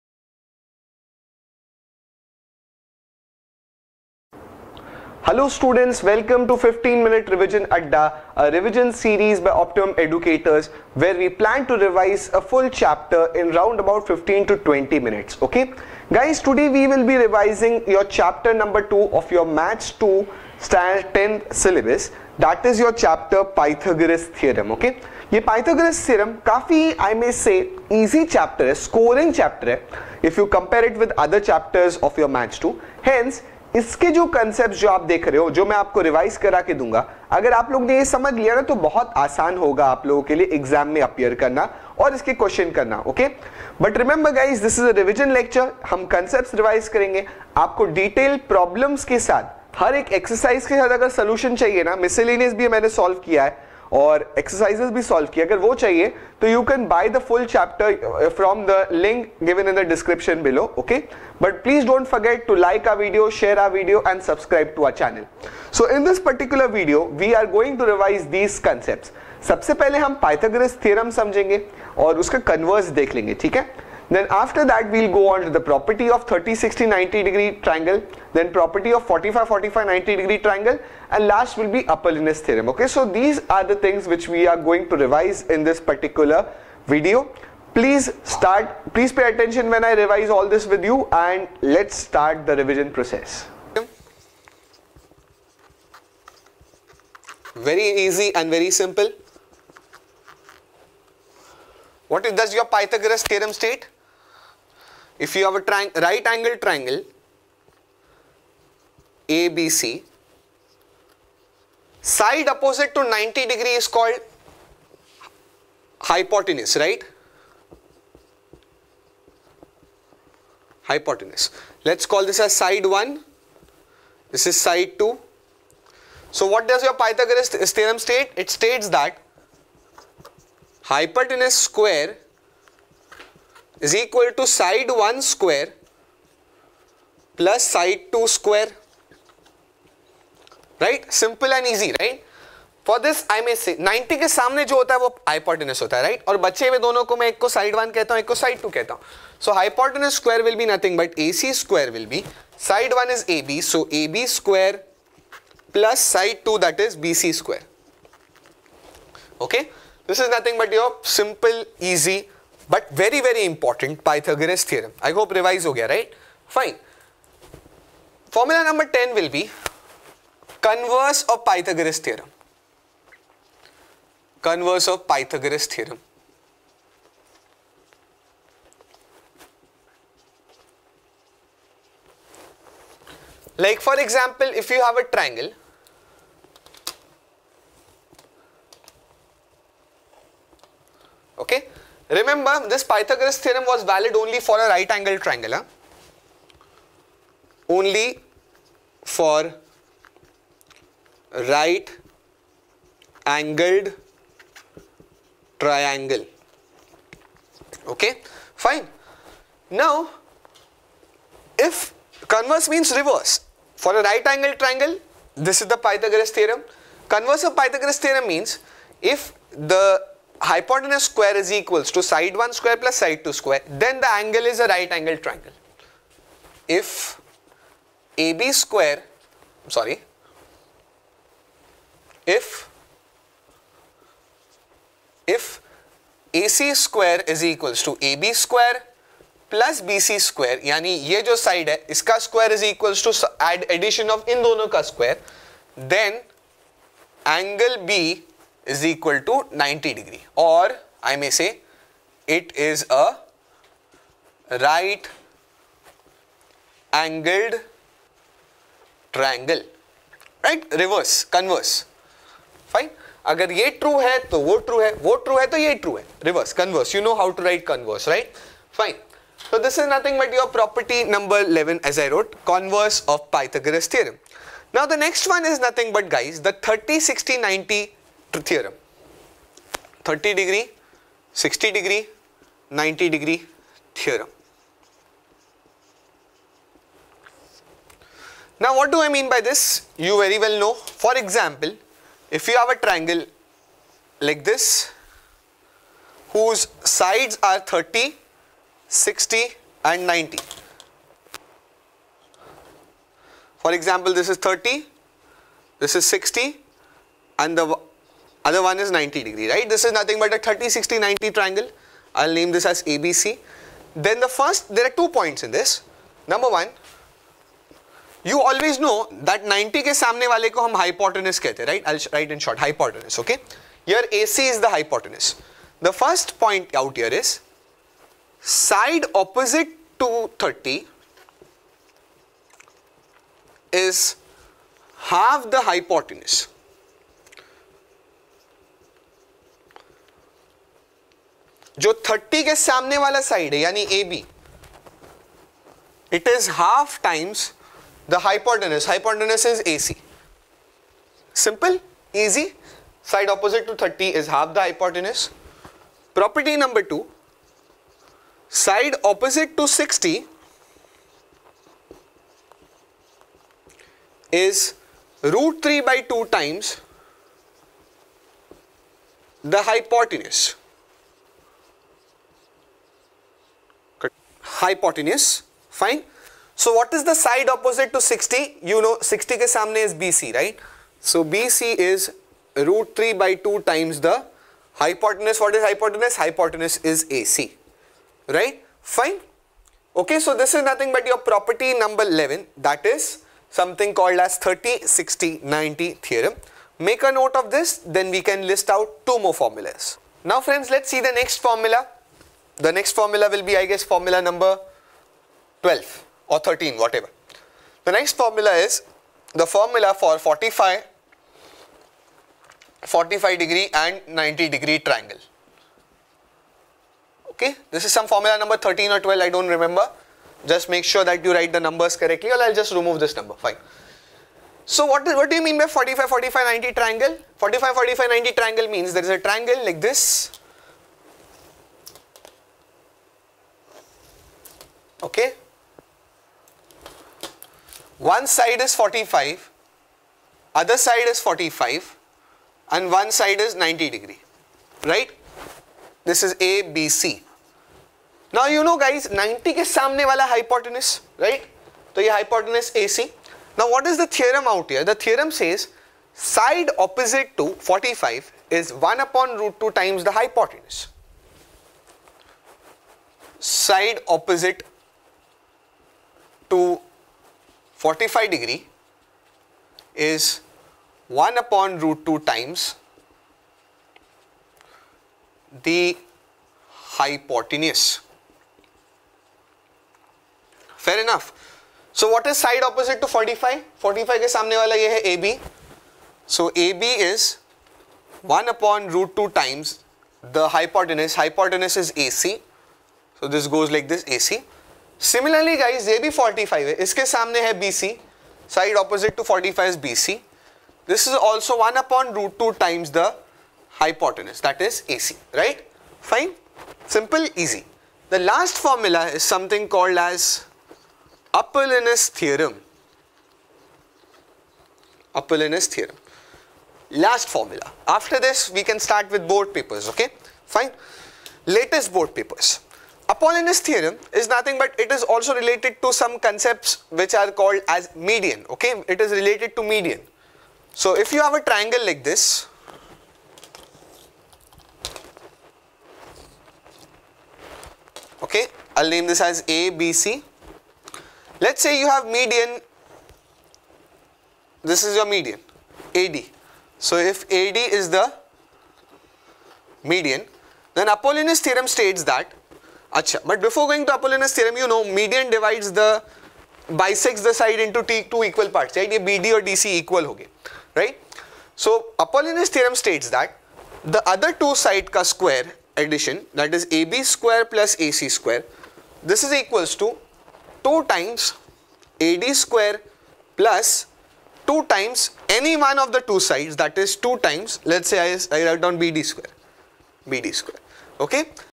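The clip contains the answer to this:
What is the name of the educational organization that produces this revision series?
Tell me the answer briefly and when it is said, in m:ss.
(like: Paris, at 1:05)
Optimum Educators, at 0:09.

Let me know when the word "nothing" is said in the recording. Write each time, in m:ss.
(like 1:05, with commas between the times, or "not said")
4:29, 4:35, 5:09, 6:30, 8:44.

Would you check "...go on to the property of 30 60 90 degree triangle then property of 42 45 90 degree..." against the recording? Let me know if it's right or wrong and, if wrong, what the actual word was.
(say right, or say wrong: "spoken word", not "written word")
wrong: "45", not "42".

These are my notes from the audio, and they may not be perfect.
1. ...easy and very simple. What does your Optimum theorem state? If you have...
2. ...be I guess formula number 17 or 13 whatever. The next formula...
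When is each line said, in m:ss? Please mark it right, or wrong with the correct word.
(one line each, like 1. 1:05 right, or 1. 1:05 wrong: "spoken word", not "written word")
1. 1:38 wrong: "Pythagoras", not "Optimum"
2. 6:43 wrong: "12", not "17".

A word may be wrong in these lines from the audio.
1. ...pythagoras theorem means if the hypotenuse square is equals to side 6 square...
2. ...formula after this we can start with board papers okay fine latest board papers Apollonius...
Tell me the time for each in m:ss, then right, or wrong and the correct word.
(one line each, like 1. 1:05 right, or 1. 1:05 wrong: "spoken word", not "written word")
1. 3:37 wrong: "1", not "6"
2. 8:37 right.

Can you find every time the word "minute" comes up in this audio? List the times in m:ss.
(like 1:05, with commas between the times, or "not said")
0:07, 0:14.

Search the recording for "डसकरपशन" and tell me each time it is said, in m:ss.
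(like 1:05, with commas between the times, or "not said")
0:59.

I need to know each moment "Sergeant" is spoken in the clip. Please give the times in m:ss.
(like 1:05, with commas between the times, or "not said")
not said.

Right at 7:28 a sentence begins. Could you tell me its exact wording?
Now you know guys, 90 ke सामने wala hypotenuse, right?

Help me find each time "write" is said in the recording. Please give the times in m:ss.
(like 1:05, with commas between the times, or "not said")
7:01, 9:38.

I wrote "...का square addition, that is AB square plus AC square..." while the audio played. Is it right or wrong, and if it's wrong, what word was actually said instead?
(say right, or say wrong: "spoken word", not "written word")
right.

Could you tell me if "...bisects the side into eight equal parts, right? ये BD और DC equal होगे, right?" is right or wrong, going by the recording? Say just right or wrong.
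wrong.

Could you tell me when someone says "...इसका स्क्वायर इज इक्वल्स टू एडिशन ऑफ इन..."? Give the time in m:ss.
4:01.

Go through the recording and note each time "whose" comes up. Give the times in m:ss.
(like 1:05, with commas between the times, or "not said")
4:56.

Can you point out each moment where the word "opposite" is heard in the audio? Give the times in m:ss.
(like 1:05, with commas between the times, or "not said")
1:52, 5:53, 5:59, 6:17, 7:36, 7:44, 8:02, 8:18.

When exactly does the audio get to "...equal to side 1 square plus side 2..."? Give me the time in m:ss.
2:13.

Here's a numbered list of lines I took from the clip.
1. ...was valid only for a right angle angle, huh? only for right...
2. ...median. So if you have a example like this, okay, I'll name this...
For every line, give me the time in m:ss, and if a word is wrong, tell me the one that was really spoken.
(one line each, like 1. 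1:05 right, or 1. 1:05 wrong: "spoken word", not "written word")
1. 3:13 wrong: "triangle", not "angle"
2. 8:49 wrong: "triangle", not "example".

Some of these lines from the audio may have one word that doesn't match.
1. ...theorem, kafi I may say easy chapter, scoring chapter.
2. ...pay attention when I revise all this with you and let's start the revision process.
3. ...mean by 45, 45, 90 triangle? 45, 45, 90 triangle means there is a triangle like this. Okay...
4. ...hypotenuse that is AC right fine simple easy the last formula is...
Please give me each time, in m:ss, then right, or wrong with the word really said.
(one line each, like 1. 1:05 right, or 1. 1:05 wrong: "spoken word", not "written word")
1. 0:26 right
2. 1:29 right
3. 7:05 right
4. 8:23 right.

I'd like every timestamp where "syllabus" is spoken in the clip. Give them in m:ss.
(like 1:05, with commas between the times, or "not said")
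0:21.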